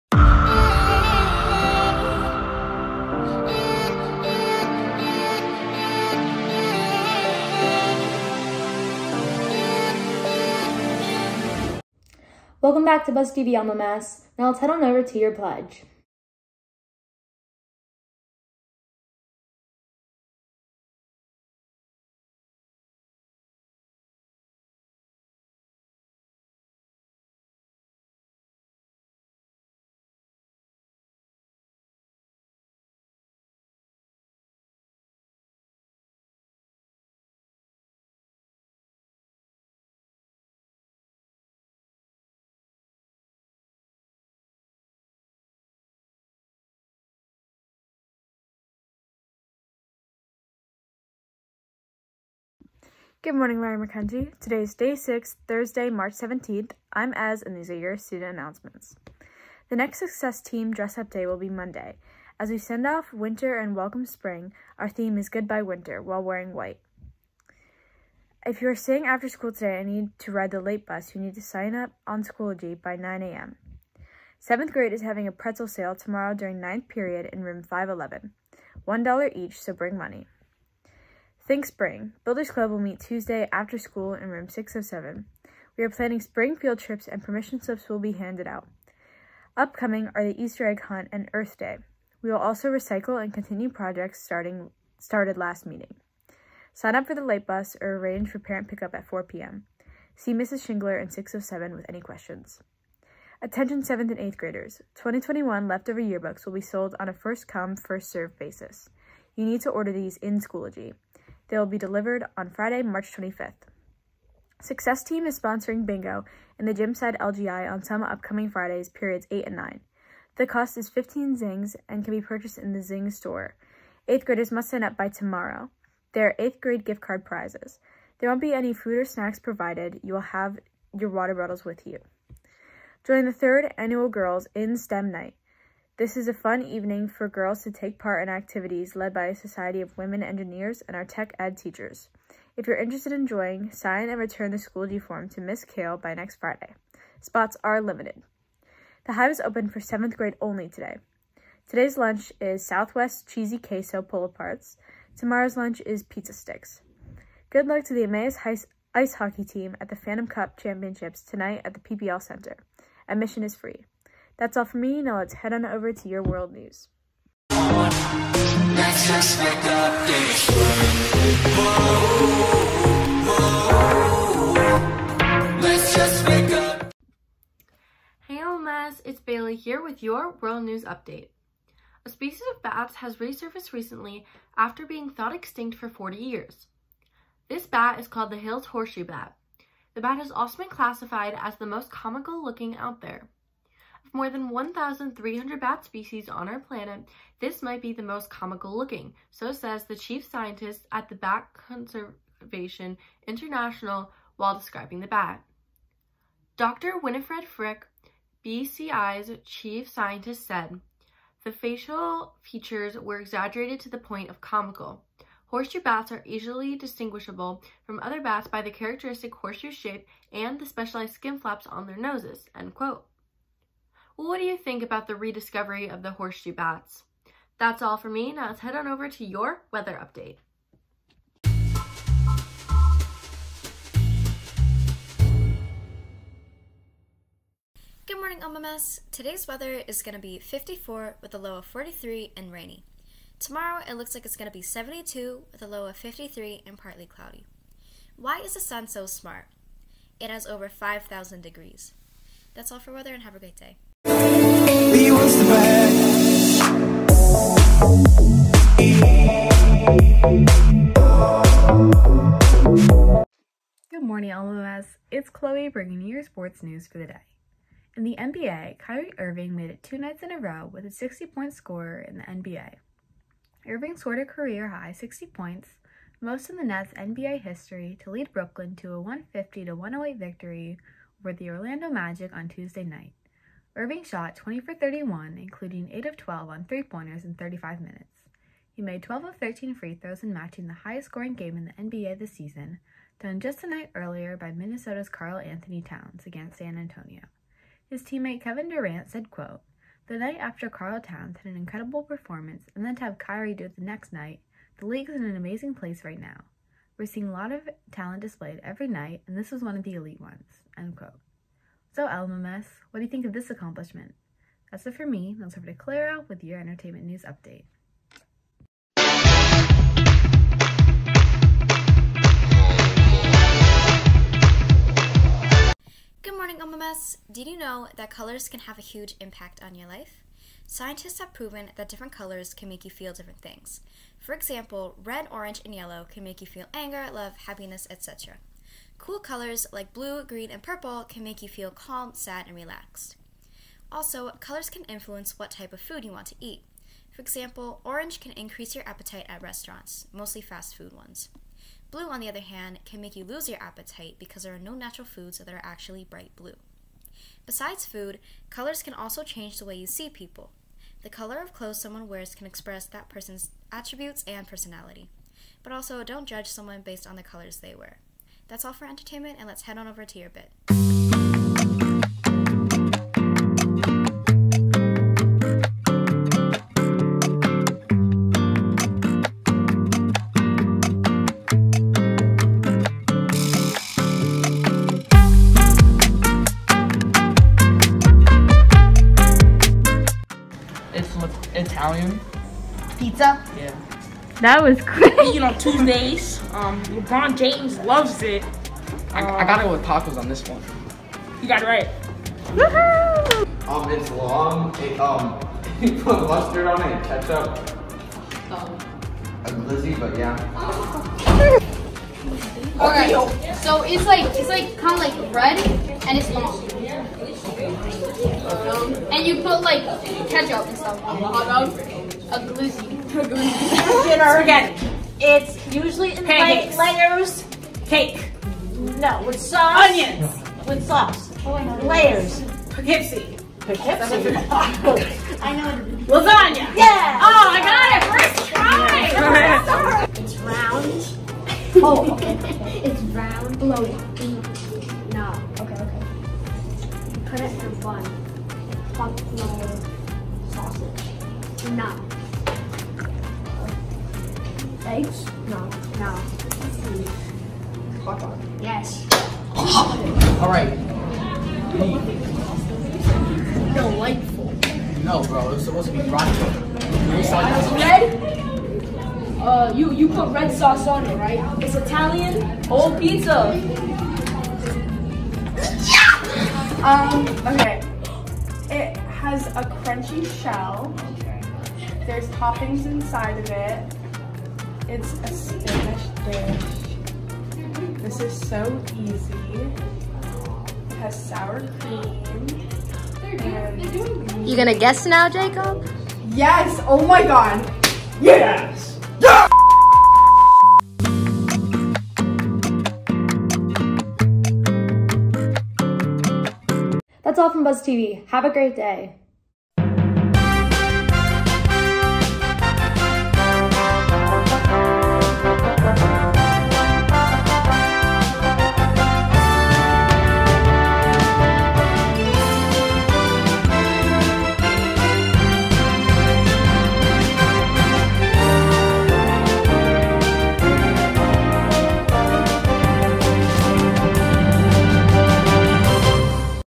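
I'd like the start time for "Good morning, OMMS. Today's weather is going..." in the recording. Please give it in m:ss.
3:58.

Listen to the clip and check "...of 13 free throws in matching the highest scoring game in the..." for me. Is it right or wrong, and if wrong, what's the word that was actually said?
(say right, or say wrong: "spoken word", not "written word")
right.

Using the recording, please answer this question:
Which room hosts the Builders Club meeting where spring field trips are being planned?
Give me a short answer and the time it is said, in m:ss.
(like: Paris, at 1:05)
607, at 1:24.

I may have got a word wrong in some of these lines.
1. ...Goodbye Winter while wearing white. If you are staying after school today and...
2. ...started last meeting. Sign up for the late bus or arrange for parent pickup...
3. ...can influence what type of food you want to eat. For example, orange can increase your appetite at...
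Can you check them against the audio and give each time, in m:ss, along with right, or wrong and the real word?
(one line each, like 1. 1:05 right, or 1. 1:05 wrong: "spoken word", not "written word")
1. 1:05 right
2. 1:34 right
3. 5:44 right.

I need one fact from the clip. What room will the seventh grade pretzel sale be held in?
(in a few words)
511.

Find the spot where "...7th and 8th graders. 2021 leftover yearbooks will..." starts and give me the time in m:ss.
1:43.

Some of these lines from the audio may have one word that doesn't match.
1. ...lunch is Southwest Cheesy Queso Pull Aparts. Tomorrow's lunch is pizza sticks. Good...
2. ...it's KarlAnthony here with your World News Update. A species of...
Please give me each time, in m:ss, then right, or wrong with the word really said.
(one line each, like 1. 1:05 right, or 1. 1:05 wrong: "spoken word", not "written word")
1. 2:31 right
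2. 2:59 wrong: "Bailey", not "KarlAnthony".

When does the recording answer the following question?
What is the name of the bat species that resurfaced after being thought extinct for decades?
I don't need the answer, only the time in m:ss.
3:08.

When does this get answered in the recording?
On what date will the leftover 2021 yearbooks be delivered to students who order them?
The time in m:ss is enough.
1:52.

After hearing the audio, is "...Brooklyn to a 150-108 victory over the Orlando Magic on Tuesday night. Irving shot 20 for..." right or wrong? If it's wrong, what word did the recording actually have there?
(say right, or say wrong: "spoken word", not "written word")
right.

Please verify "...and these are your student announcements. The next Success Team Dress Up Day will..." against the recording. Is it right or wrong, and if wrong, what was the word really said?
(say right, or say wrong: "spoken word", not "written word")
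right.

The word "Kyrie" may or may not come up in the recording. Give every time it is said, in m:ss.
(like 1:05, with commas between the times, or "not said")
4:28, 5:03.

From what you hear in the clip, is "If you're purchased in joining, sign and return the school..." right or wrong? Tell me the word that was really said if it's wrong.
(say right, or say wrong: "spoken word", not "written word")
wrong: "interested", not "purchased".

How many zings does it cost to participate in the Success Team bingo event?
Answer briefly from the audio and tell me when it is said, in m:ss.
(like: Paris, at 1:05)
15, at 2:00.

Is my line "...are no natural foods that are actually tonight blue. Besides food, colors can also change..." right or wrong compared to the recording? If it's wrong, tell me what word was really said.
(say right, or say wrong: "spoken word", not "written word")
wrong: "bright", not "tonight".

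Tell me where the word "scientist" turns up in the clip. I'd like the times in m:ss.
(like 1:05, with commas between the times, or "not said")
3:20, 3:29, 5:30.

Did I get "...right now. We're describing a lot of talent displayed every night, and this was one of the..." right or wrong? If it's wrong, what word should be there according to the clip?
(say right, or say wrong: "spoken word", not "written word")
wrong: "seeing", not "describing".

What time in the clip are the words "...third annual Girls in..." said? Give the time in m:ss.
2:13.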